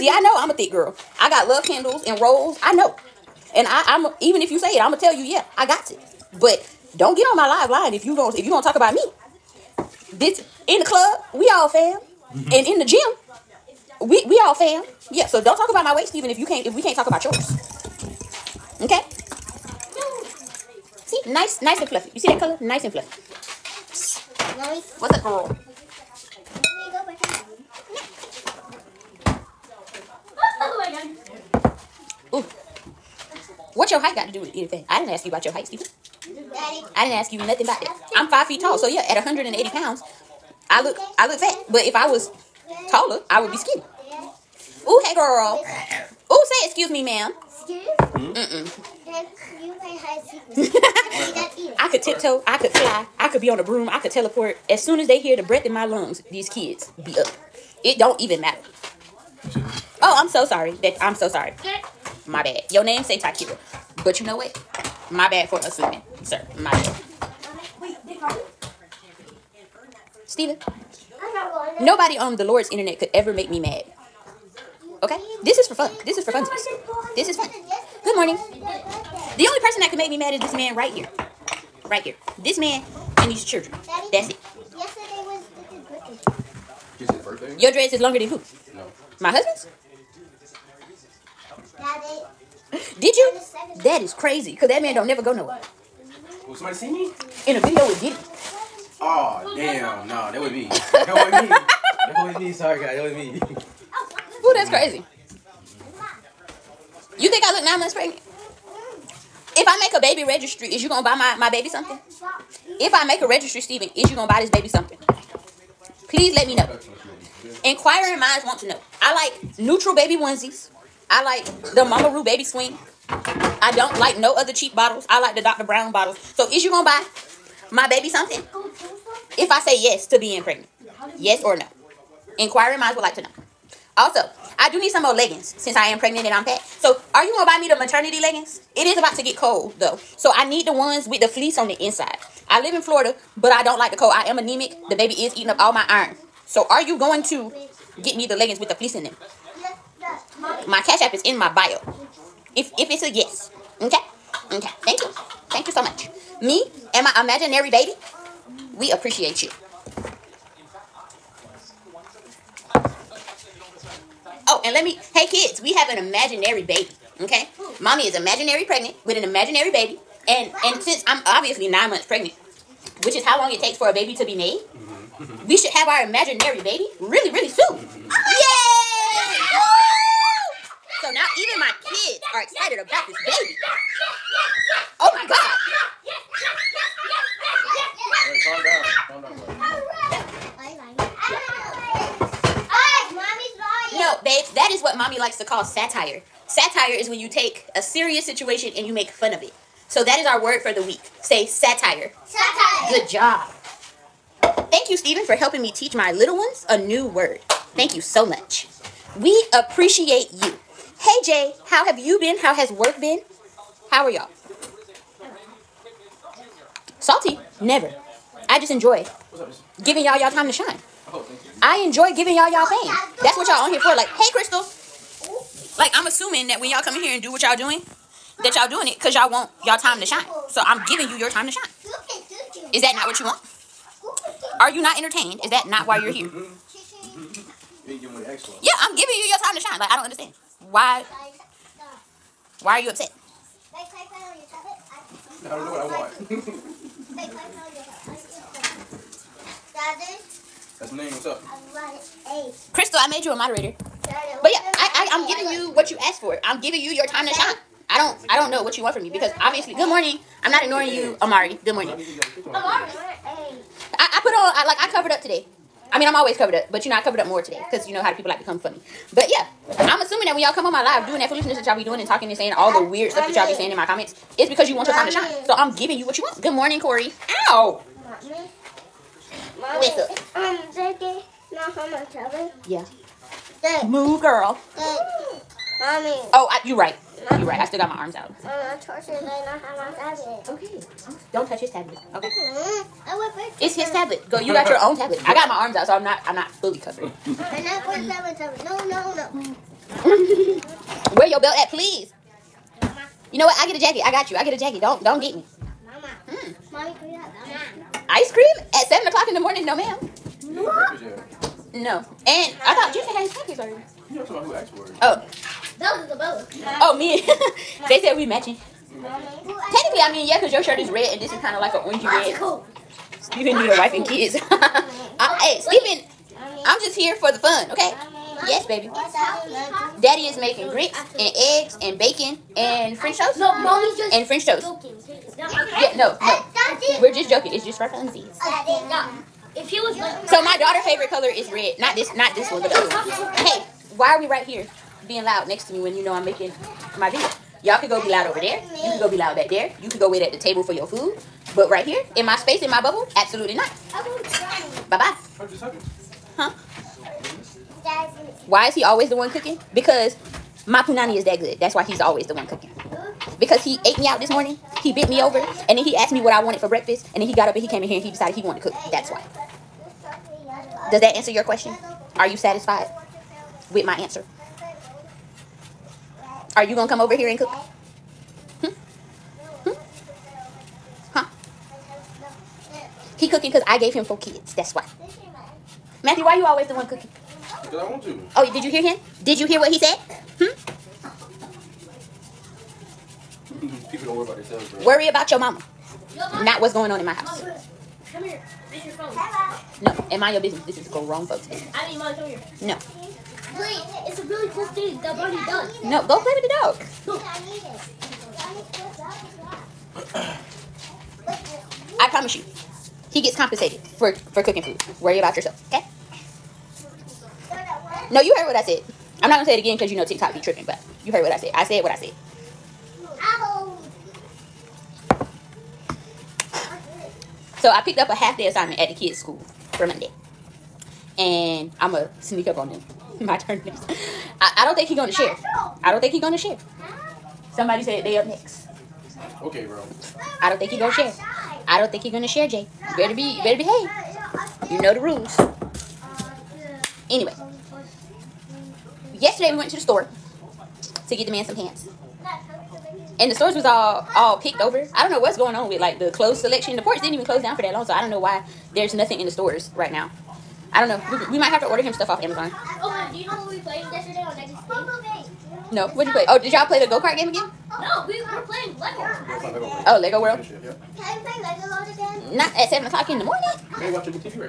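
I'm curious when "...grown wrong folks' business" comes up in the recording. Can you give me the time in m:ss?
6:40.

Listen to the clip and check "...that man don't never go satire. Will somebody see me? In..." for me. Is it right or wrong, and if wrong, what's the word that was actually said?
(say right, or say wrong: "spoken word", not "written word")
wrong: "nowhere", not "satire".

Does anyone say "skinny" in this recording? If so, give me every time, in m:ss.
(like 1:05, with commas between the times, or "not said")
0:43.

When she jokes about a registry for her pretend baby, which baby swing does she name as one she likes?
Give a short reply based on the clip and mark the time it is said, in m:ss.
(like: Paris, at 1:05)
MamaRoo, at 2:01.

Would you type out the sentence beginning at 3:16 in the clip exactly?
Satire is when you take a serious situation and you make fun of it.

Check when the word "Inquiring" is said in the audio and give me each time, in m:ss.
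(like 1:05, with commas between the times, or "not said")
1:57, 2:12.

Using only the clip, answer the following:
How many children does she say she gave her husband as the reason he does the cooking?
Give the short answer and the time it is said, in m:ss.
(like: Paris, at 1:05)
4, at 6:24.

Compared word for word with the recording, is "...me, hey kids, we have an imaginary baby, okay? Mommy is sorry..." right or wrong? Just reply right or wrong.
wrong.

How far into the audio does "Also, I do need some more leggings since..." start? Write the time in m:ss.
2:13.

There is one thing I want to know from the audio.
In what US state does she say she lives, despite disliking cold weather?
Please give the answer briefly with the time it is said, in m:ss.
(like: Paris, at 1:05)
Florida, at 2:22.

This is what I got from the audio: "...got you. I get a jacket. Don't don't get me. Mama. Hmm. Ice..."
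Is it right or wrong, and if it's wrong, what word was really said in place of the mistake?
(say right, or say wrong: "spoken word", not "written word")
right.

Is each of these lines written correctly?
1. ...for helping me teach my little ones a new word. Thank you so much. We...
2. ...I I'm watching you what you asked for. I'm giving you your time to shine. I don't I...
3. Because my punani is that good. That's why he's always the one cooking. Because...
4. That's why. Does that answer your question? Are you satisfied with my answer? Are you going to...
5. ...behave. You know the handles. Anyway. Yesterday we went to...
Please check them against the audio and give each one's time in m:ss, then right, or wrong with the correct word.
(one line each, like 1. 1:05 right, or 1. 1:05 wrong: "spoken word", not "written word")
1. 3:25 right
2. 4:14 wrong: "giving", not "watching"
3. 5:59 right
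4. 6:08 right
5. 7:23 wrong: "rules", not "handles".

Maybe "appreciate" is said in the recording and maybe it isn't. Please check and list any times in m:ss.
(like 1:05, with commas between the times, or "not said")
2:38, 3:29.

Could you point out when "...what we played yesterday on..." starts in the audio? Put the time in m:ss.
7:43.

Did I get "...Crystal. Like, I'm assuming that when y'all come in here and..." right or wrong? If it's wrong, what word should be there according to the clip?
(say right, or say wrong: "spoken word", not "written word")
right.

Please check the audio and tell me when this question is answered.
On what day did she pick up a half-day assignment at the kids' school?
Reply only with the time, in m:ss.
7:09.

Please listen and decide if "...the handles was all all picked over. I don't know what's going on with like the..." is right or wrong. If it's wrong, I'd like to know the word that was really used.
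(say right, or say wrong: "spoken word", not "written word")
wrong: "stores", not "handles".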